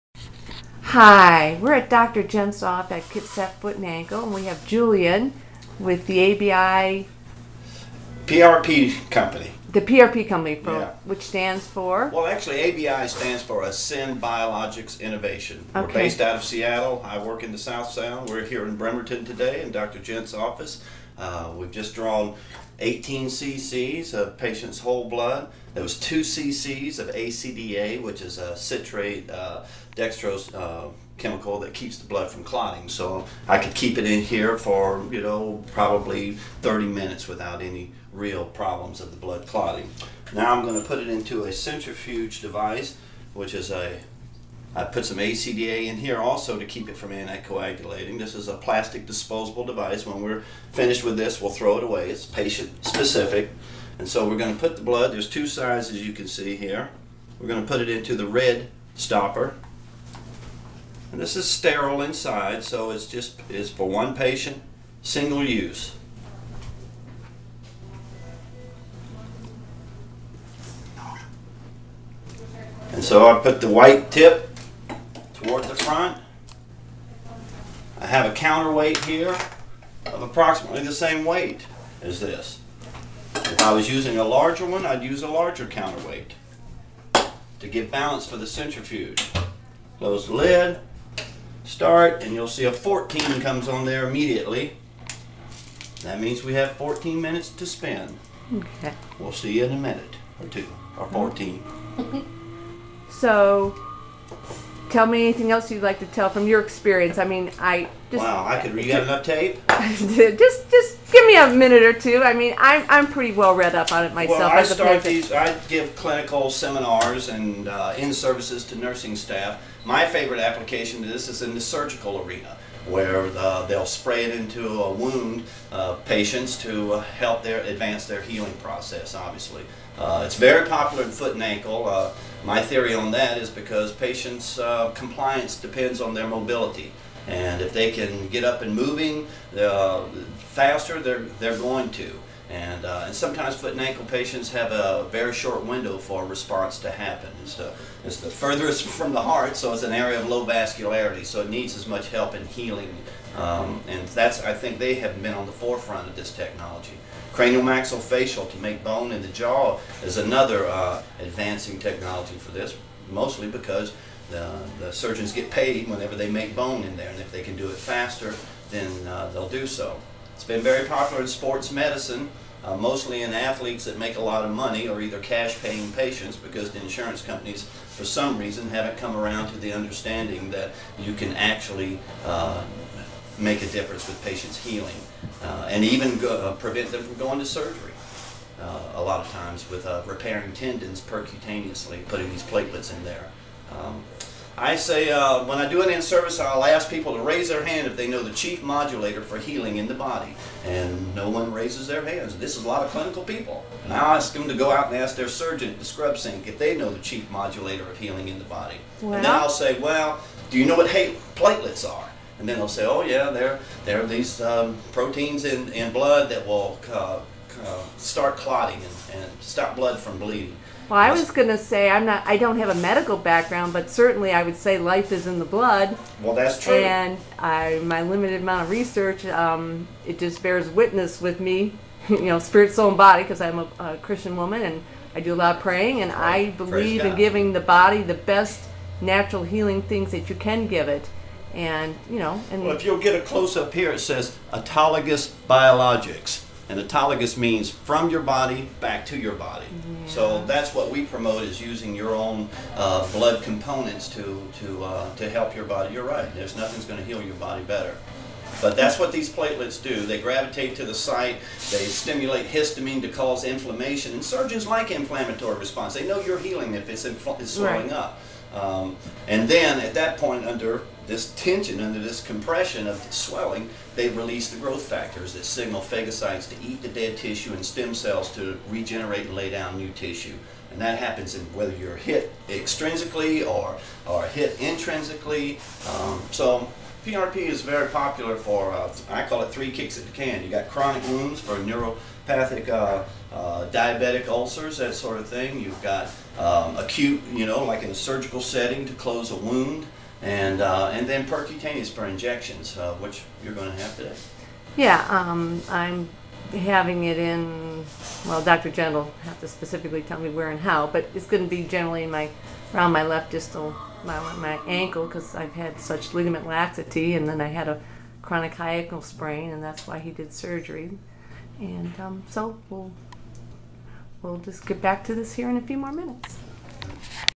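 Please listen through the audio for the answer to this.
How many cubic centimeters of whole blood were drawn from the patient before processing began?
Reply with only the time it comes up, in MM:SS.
00:22.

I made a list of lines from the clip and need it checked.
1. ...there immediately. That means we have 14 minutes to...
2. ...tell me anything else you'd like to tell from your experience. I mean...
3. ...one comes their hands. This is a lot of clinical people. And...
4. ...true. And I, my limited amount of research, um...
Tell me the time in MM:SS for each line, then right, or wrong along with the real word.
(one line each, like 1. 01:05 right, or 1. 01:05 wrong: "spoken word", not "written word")
1. 01:33 right
2. 01:44 right
3. 03:21 wrong: "raises", not "comes"
4. 03:46 right.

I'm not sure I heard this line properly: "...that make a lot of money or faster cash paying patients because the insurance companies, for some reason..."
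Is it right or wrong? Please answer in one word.
wrong.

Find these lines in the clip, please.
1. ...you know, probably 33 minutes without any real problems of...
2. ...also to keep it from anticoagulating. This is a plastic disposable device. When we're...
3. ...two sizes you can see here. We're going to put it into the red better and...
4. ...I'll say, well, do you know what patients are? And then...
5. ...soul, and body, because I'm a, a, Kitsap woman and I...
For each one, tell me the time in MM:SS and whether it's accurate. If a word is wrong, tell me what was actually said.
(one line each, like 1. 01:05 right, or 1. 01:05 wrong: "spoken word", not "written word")
1. 00:35 wrong: "30", not "33"
2. 00:46 right
3. 00:55 wrong: "stopper", not "better"
4. 03:29 wrong: "platelets", not "patients"
5. 03:52 wrong: "Christian", not "Kitsap".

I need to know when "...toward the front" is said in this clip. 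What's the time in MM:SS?
01:15.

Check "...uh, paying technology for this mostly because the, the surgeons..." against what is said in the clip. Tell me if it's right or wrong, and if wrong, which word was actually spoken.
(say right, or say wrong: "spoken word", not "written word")
wrong: "advancing", not "paying".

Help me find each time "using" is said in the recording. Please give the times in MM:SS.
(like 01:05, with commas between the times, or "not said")
01:23, 04:11.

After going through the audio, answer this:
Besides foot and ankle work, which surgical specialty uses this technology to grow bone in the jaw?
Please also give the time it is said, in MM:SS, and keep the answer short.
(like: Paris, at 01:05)
Cranial maxillofacial, at 02:37.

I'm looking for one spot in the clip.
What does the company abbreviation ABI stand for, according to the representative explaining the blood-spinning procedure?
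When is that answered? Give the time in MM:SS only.
00:13.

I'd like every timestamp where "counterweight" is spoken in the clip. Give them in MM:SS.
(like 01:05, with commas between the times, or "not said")
01:18, 01:25.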